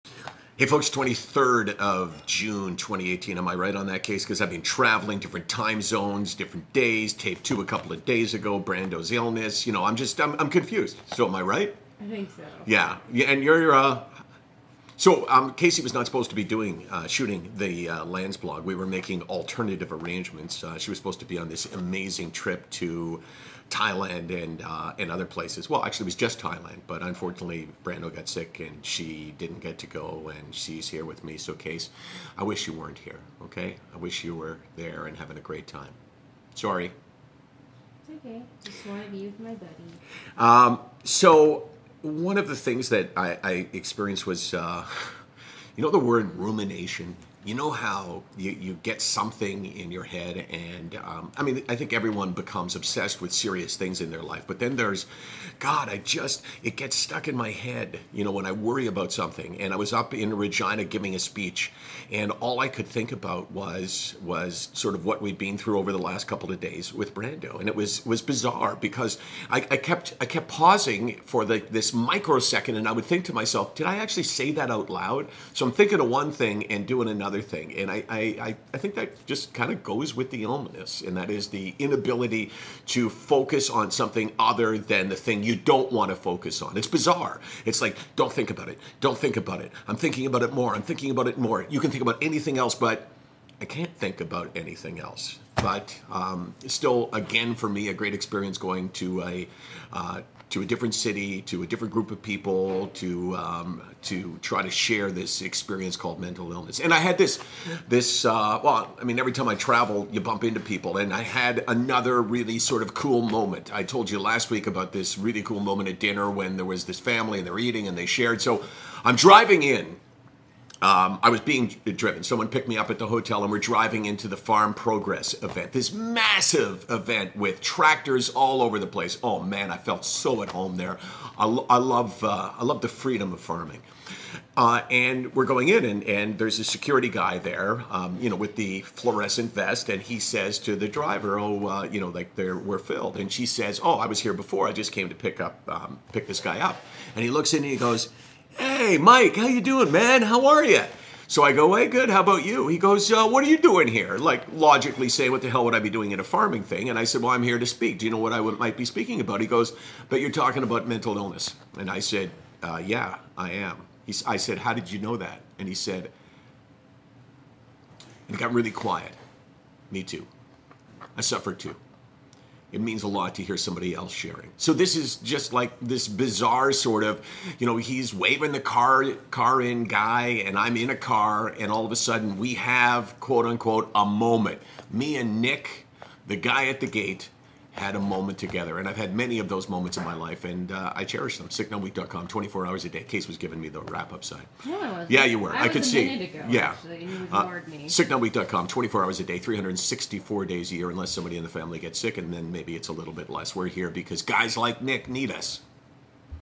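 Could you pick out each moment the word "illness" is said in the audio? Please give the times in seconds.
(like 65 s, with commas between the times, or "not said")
9 s, 80 s, 106 s, 161 s.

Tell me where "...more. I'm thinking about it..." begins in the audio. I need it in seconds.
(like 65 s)
90 s.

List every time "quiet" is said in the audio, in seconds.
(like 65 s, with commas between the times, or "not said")
168 s.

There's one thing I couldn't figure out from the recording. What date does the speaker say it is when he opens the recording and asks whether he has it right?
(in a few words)
23 June 2018.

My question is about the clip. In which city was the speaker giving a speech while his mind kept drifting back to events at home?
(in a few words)
Regina.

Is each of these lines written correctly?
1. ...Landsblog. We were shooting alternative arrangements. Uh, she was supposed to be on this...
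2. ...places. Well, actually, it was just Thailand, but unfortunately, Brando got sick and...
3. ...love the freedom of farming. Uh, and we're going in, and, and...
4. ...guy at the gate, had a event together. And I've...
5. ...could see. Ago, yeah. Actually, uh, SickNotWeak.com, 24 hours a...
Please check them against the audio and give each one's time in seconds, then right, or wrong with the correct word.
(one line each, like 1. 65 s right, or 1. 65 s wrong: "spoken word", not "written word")
1. 18 s wrong: "making", not "shooting"
2. 25 s right
3. 132 s right
4. 186 s wrong: "moment", not "event"
5. 195 s right.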